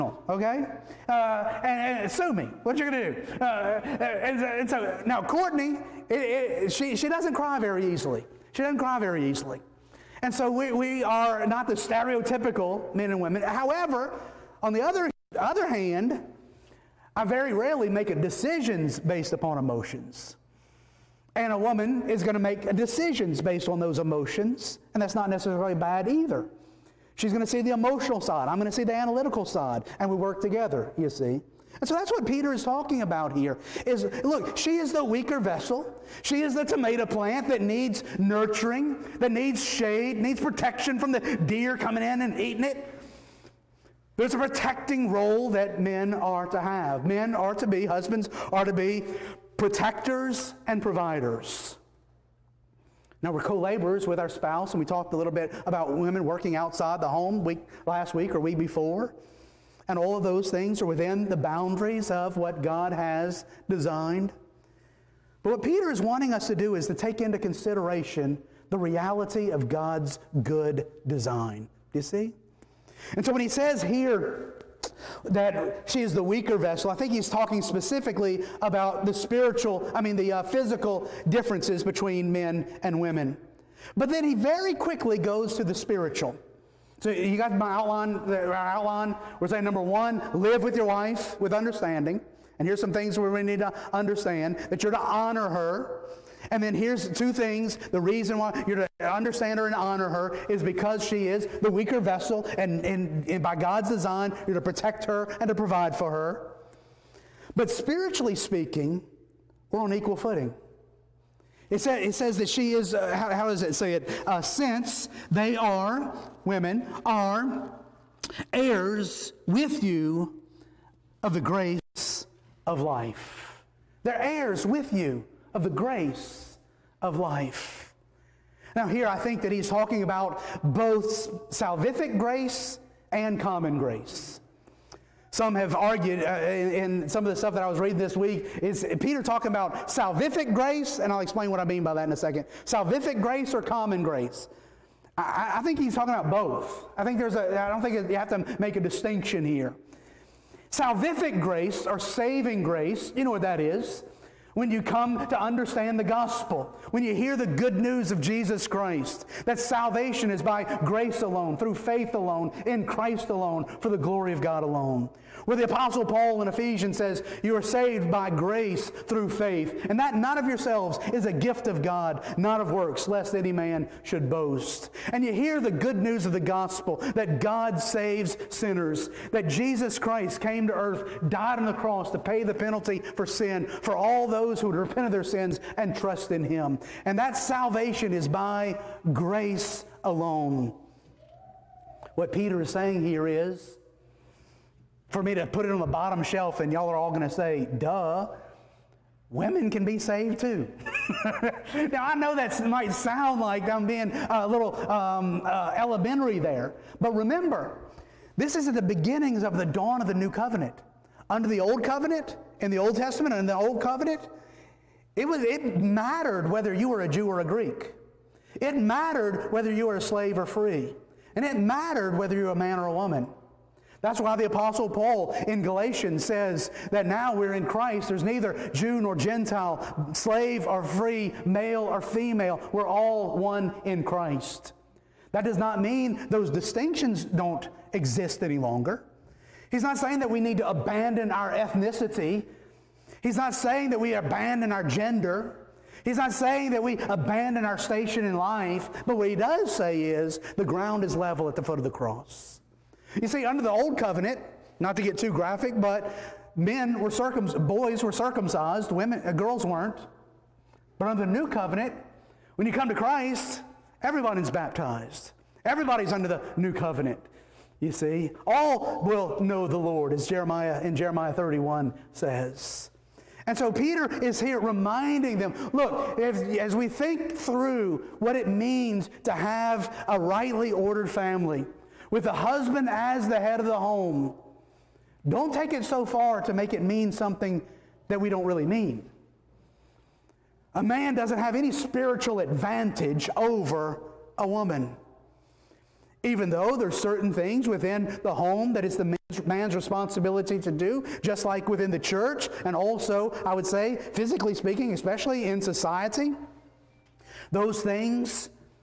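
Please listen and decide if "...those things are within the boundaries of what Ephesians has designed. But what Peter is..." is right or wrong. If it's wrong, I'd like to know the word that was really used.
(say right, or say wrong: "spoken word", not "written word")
wrong: "God", not "Ephesians".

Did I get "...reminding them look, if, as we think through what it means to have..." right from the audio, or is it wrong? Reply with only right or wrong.
right.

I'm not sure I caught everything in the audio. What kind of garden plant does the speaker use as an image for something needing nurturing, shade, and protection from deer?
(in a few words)
tomato plant.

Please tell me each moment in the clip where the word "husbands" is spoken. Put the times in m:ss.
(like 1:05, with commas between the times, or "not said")
0:47, 4:42.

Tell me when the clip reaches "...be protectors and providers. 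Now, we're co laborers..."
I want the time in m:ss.
0:48.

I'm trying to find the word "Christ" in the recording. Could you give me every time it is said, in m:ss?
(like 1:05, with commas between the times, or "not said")
2:38, 2:42, 2:59, 3:47, 3:54, 4:22.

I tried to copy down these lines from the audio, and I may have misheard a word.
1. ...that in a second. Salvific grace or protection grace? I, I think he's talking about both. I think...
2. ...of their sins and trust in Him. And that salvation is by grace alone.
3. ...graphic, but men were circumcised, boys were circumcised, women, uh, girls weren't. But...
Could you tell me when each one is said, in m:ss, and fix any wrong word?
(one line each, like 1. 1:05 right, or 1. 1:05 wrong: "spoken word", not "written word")
1. 2:21 wrong: "common", not "protection"
2. 3:05 right
3. 4:15 right.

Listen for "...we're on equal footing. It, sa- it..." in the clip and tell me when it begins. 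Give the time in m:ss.
1:49.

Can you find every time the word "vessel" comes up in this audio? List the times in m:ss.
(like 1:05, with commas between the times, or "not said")
0:35, 1:16, 1:41.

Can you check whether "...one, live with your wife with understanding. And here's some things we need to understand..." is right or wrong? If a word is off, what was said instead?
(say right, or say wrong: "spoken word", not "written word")
right.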